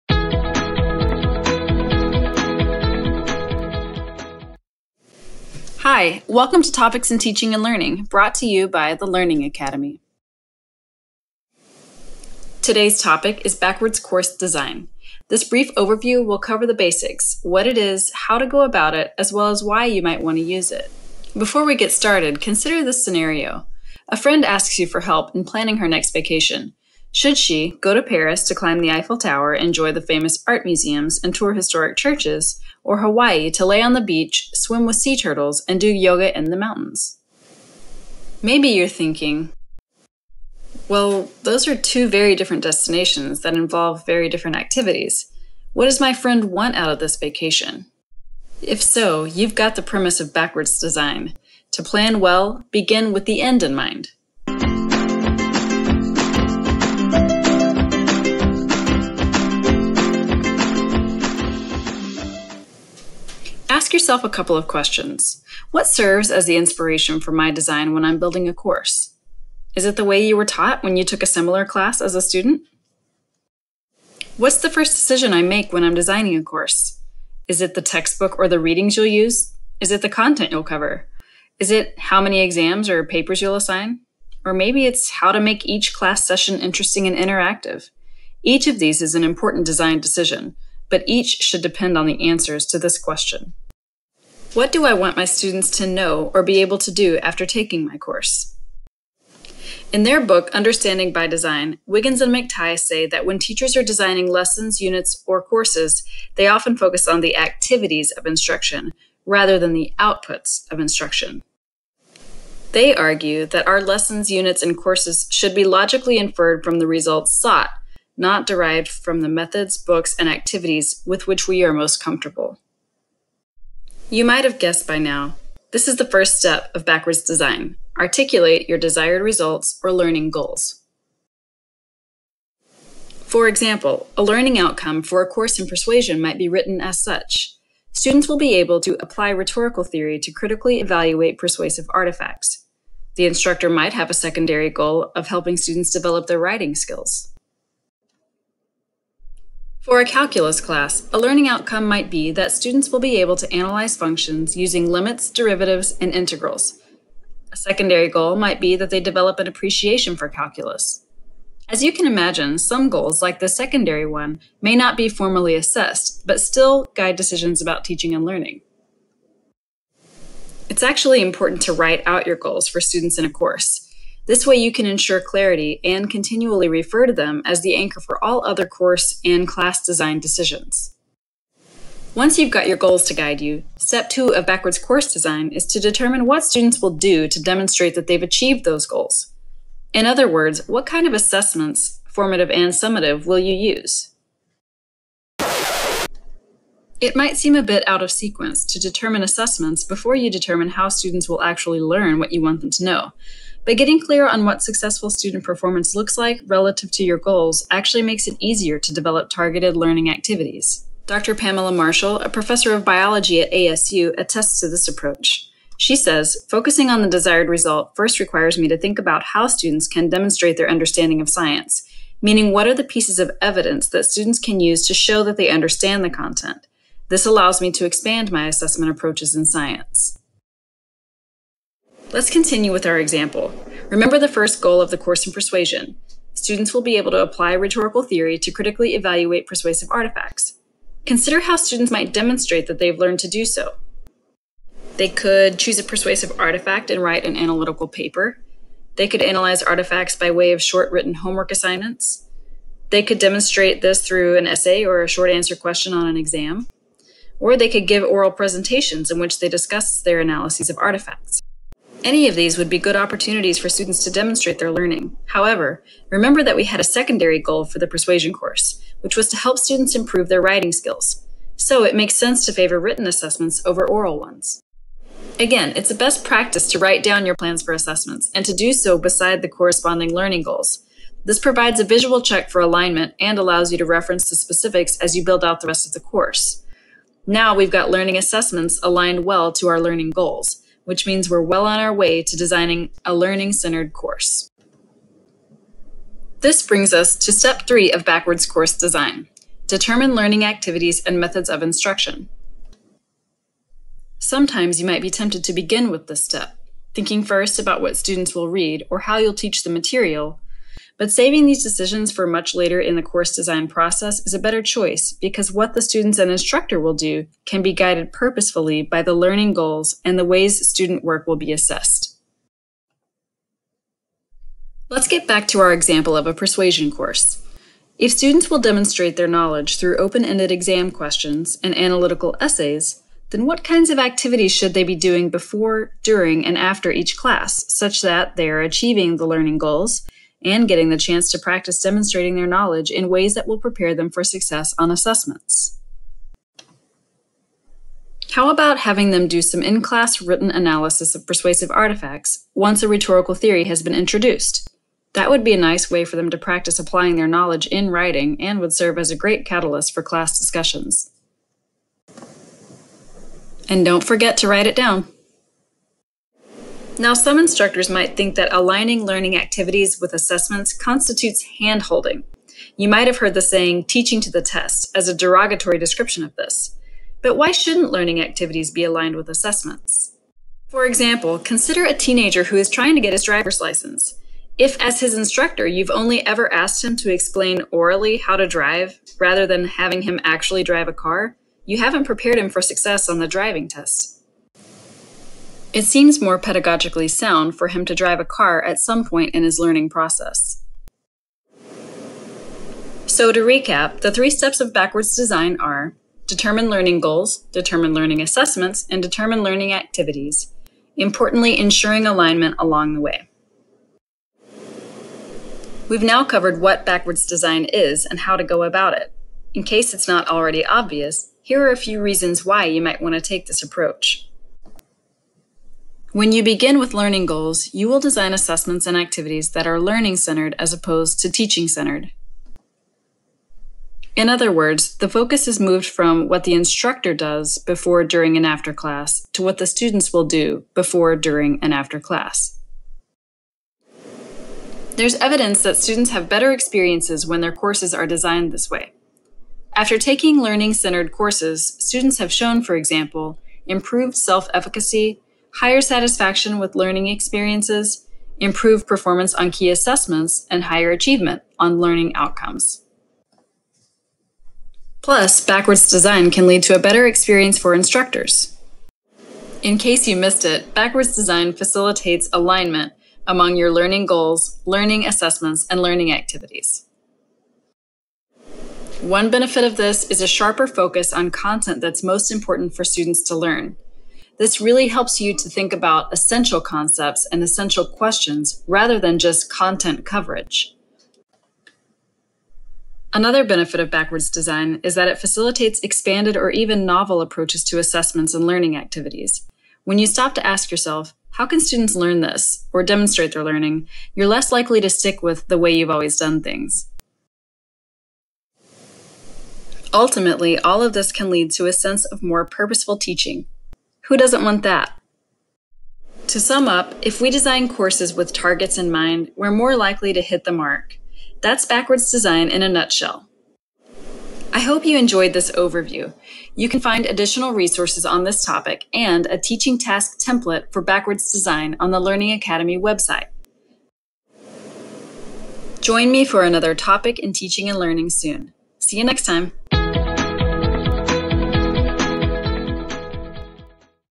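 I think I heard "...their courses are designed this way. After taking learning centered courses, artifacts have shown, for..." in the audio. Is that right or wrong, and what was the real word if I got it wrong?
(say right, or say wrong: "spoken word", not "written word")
wrong: "students", not "artifacts".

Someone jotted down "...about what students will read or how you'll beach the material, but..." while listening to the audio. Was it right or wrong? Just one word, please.
wrong.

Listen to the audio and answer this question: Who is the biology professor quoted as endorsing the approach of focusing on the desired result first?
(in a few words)
Pamela Marshall.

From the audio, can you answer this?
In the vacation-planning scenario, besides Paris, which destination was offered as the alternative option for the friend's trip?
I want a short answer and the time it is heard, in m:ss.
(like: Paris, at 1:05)
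Hawaii, at 0:32.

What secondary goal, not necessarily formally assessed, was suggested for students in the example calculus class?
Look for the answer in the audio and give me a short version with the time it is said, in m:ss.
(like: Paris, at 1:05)
appreciation for calculus, at 2:39.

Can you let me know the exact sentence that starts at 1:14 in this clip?
What's the first decision I make when I'm designing a course?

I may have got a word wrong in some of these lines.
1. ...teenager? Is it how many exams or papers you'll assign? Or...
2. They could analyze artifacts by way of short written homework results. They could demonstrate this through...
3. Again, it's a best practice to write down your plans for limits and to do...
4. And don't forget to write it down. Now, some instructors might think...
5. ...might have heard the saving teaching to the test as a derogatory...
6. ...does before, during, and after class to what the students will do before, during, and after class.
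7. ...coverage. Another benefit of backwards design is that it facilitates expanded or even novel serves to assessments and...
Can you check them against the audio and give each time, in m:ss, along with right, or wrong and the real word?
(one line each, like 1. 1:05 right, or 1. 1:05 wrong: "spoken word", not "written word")
1. 1:20 wrong: "cover", not "teenager"
2. 4:08 wrong: "assignments", not "results"
3. 4:35 wrong: "assessments", not "limits"
4. 6:03 right
5. 6:12 wrong: "saying", not "saving"
6. 7:17 right
7. 8:10 wrong: "approaches", not "serves".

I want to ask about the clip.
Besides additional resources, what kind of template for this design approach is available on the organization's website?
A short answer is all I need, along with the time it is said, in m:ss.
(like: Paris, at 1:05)
teaching task template, at 8:49.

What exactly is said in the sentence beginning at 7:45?
Plus, backwards design can lead to a better experience for instructors.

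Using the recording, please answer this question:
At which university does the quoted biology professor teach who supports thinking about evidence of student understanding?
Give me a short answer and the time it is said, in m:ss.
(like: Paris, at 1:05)
ASU, at 3:33.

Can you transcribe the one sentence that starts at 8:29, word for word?
Ultimately, all of this can lead to a sense of more purposeful teaching, who doesn't want that?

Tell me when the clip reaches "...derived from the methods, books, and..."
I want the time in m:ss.
1:58.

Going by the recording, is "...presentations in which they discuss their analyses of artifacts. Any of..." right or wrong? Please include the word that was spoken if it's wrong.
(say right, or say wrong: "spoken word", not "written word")
right.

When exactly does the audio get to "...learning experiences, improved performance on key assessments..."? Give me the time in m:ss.
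7:36.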